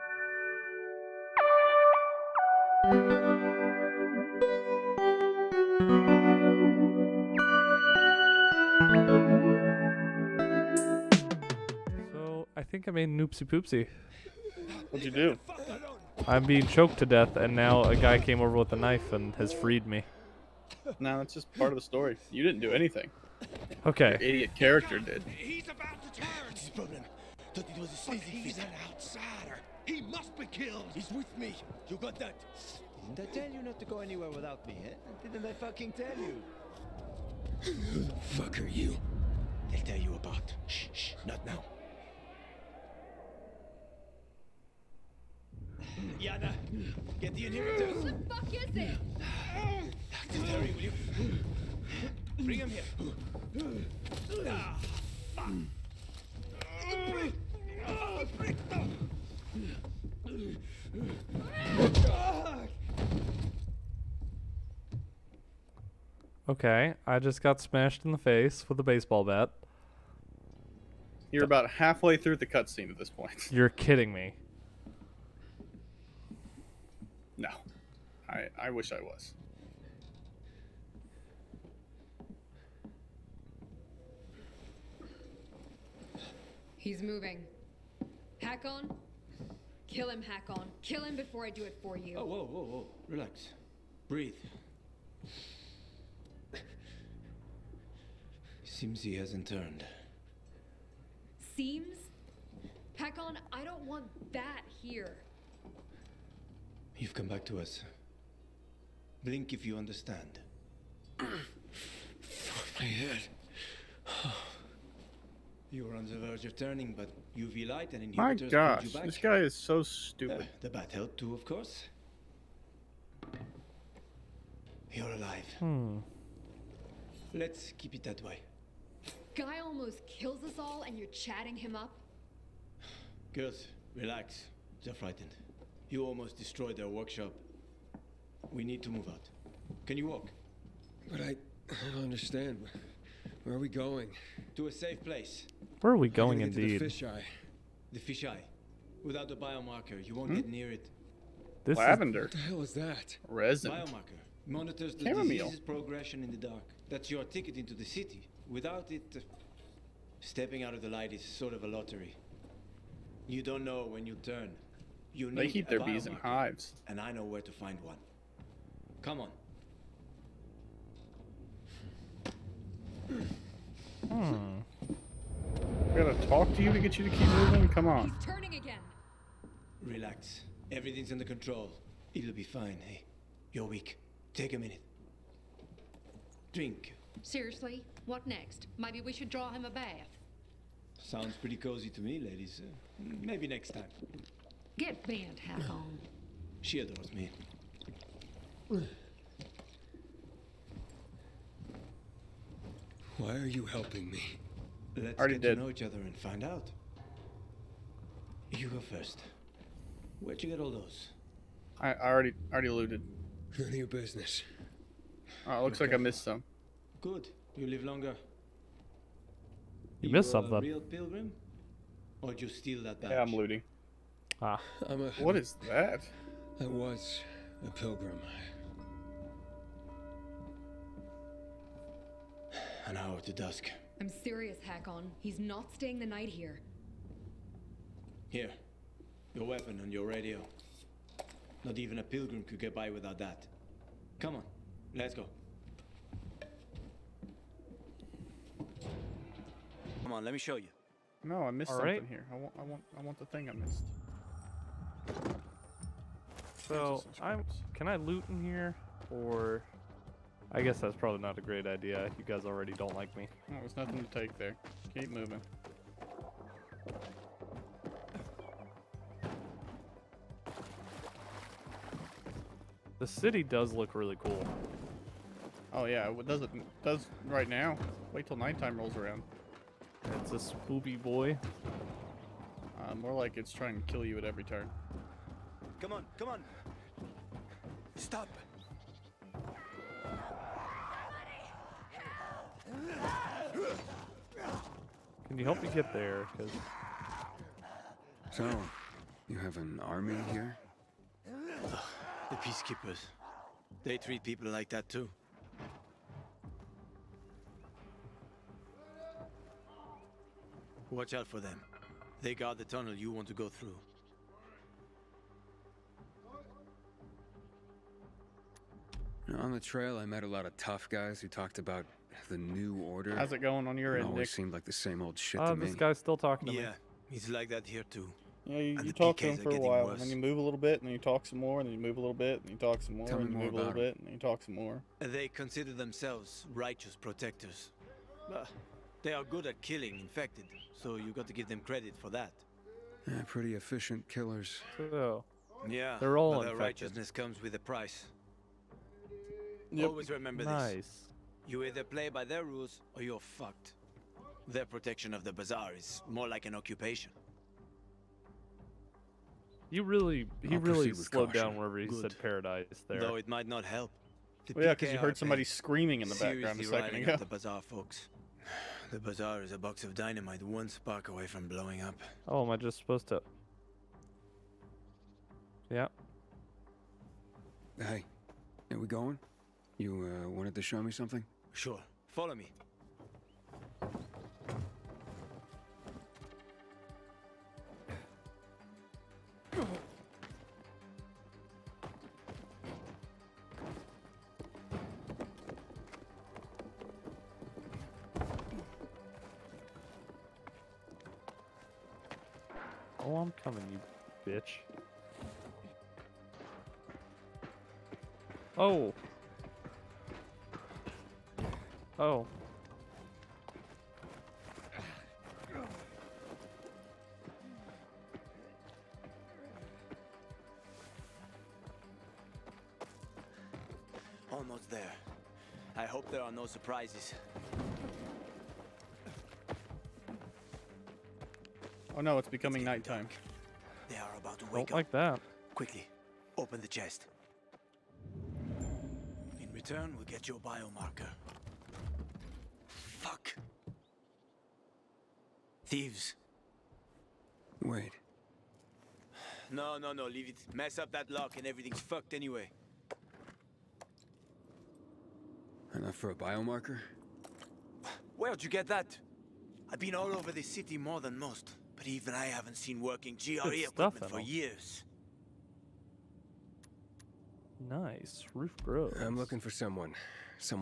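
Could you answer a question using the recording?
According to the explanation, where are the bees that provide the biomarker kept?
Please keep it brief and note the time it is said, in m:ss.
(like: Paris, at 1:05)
In hives, at 2:46.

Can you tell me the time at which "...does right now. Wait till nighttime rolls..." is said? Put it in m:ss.
4:36.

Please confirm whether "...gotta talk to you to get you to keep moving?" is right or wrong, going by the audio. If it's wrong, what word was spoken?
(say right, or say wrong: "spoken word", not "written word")
right.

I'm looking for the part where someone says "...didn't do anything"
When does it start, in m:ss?
0:22.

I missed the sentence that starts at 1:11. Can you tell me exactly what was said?
You're about halfway through the cutscene at this point.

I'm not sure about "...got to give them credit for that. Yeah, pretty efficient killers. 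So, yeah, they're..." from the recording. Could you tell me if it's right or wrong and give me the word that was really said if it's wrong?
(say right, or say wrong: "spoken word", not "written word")
right.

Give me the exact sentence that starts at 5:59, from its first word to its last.
You really, he I'll really slowed caution.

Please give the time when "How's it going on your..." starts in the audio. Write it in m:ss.
5:23.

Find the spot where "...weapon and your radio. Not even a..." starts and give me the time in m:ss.
3:59.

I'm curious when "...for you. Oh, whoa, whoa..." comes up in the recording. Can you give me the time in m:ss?
1:31.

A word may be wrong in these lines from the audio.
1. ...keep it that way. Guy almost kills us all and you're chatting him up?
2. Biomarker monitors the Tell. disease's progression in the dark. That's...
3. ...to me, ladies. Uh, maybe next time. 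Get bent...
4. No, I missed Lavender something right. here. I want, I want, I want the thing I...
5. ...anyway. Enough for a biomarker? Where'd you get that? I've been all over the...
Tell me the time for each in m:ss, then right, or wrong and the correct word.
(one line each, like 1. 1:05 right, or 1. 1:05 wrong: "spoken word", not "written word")
1. 2:07 right
2. 2:33 wrong: "Chamomile", not "Tell"
3. 3:11 right
4. 4:11 wrong: "All", not "Lavender"
5. 7:32 right.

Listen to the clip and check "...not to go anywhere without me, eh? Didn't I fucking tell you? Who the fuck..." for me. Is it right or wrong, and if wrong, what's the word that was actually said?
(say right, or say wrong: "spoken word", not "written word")
right.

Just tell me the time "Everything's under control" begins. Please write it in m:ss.
3:00.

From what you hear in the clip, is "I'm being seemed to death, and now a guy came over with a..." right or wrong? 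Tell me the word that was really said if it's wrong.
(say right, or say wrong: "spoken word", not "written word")
wrong: "choked", not "seemed".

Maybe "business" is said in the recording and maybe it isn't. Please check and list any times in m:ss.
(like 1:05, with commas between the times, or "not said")
3:33.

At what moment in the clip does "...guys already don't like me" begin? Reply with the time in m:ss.
4:22.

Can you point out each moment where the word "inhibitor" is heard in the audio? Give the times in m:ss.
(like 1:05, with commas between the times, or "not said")
0:47, 1:58.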